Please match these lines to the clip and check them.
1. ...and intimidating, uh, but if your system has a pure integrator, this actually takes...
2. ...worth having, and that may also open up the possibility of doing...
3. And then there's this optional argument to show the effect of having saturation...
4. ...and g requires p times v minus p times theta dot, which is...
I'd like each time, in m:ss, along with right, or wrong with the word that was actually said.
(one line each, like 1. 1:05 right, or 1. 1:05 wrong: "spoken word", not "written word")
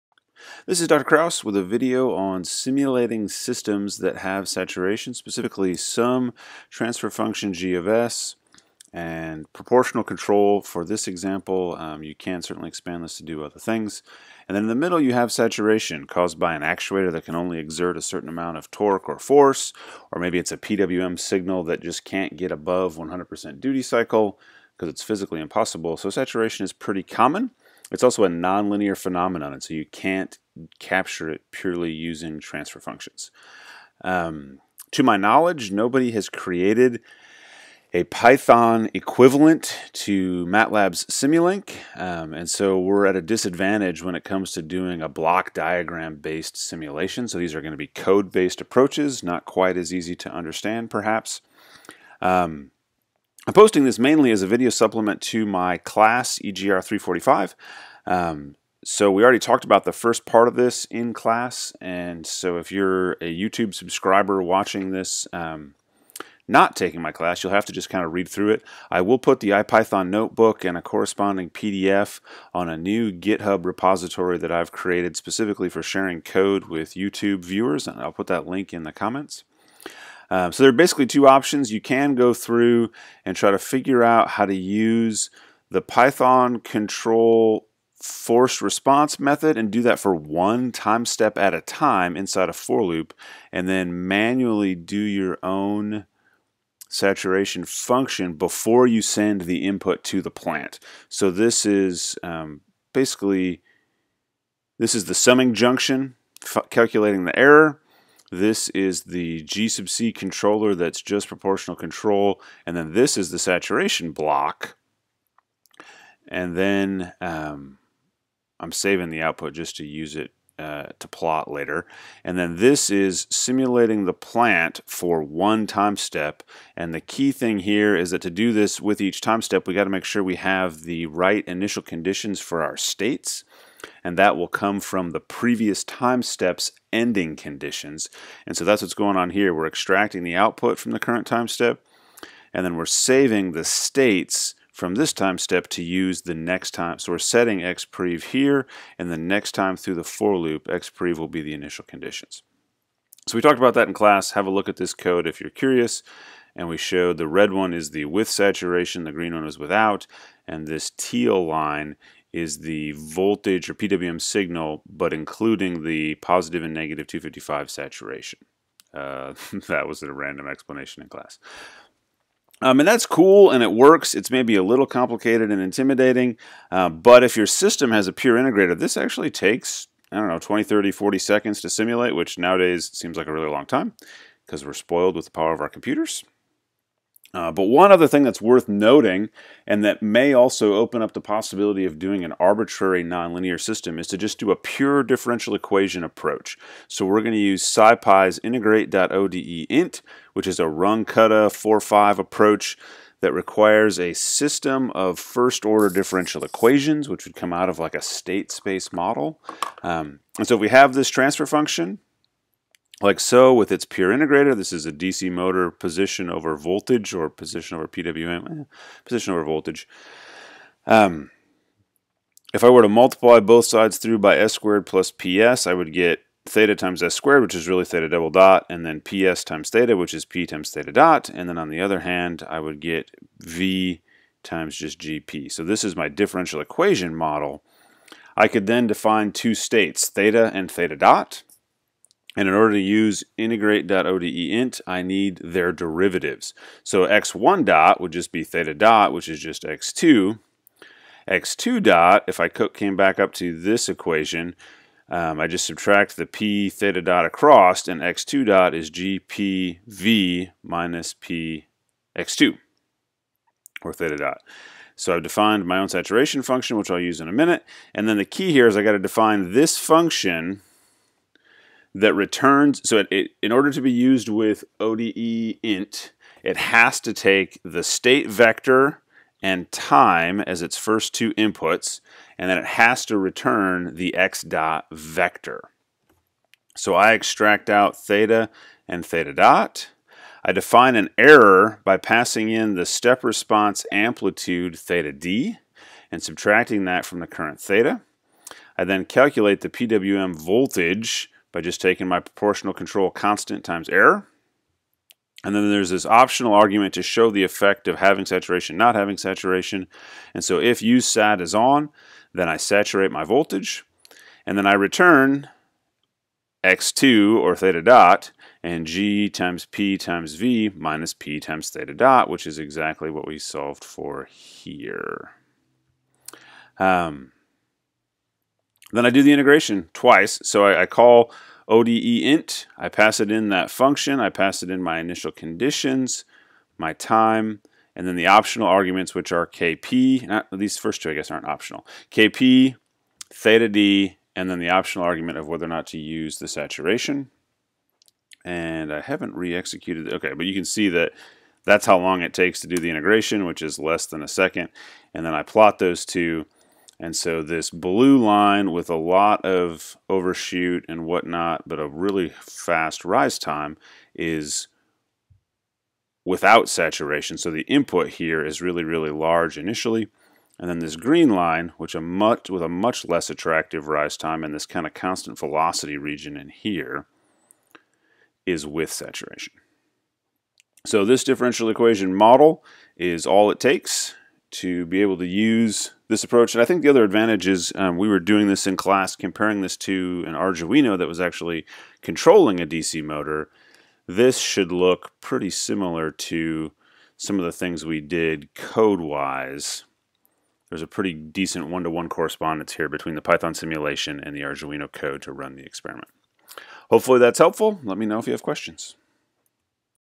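1. 2:55 right
2. 3:08 wrong: "noting", not "having"
3. 5:05 right
4. 5:18 wrong: "times", not "requires".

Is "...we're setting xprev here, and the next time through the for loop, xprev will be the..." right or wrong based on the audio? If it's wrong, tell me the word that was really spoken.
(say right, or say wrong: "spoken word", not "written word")
right.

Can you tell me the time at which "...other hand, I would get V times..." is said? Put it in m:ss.
3:51.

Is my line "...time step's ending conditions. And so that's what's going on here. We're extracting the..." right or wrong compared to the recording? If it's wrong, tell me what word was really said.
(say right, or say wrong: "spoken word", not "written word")
right.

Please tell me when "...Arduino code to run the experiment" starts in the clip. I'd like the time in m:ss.
6:44.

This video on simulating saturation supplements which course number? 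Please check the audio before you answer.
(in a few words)
EGR 345.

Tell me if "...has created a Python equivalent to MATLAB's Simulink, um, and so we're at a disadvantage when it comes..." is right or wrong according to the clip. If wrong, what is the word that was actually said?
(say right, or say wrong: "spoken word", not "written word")
right.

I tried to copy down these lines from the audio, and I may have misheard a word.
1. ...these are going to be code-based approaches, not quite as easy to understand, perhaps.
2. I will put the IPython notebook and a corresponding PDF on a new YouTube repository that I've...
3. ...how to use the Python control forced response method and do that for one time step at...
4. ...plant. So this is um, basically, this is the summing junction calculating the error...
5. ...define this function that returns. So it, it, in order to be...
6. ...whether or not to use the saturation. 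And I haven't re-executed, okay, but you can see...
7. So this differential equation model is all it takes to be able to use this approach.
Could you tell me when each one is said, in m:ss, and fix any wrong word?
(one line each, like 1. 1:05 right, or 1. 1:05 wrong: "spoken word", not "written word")
1. 0:47 right
2. 1:08 wrong: "GitHub", not "YouTube"
3. 1:24 right
4. 1:40 right
5. 4:28 right
6. 5:45 right
7. 6:20 right.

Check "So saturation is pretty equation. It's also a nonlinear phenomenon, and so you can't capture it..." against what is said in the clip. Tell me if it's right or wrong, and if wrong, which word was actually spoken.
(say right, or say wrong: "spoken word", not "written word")
wrong: "common", not "equation".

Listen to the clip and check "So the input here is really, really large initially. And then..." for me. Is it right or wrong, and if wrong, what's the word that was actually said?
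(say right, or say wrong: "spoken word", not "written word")
right.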